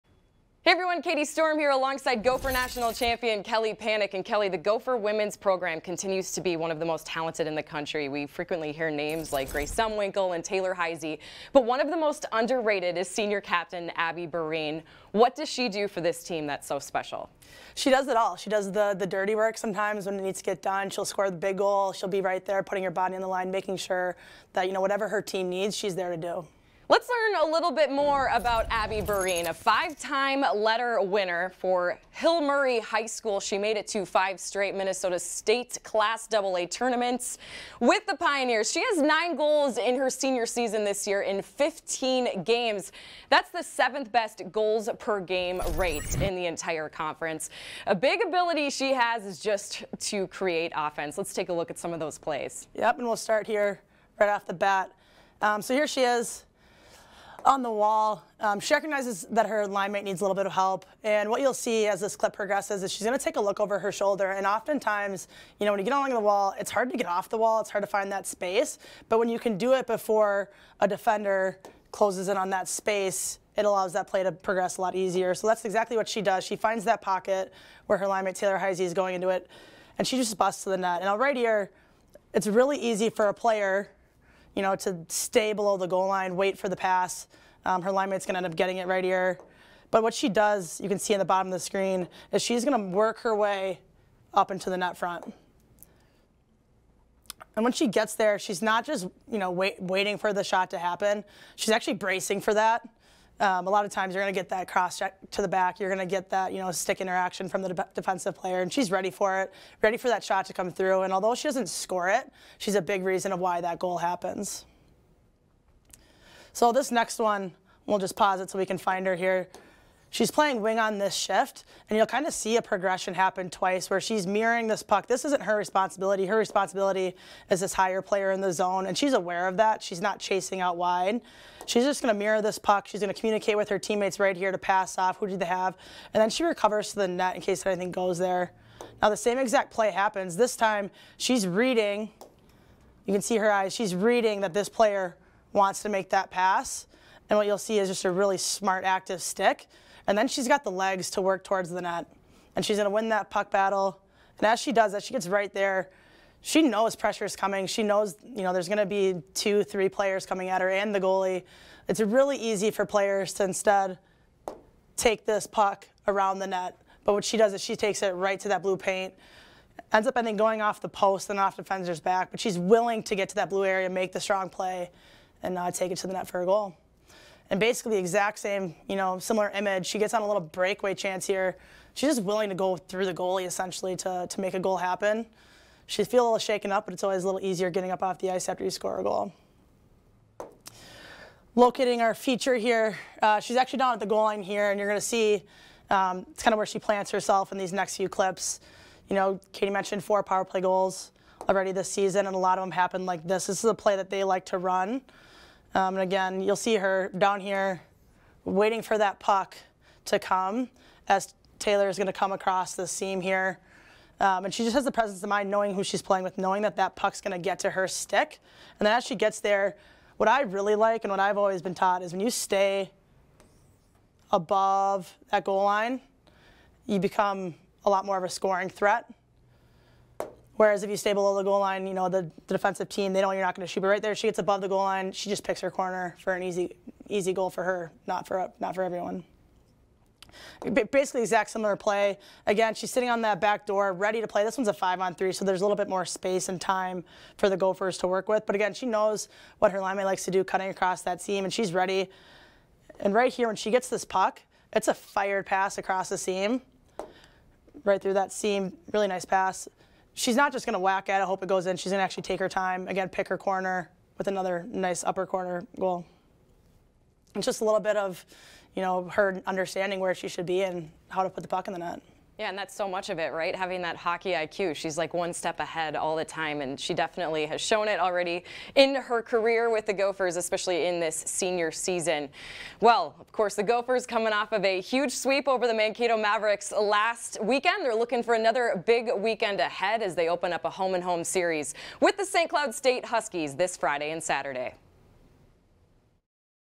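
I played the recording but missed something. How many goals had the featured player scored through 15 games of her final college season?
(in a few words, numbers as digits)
9.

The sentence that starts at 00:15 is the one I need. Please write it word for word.
What does she do for this team that's so special?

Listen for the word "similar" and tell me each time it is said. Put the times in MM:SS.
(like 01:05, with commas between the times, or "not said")
02:59, 04:01.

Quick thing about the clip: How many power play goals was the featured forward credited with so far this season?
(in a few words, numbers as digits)
4.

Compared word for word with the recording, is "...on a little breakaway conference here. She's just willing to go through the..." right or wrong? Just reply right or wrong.
wrong.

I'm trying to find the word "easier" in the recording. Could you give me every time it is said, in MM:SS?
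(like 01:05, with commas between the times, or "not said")
01:14, 03:07.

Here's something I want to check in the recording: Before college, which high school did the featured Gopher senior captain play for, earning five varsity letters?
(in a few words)
Hill Murray High School.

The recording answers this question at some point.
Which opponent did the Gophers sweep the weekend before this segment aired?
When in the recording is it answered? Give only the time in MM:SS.
04:45.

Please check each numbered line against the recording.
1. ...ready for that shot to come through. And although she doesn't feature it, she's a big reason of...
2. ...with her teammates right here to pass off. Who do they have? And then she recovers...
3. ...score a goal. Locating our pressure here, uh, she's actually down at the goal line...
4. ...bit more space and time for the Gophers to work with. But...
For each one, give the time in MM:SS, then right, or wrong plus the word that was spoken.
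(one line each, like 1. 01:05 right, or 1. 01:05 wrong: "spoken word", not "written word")
1. 01:49 wrong: "score", not "feature"
2. 02:13 right
3. 03:08 wrong: "feature", not "pressure"
4. 04:05 right.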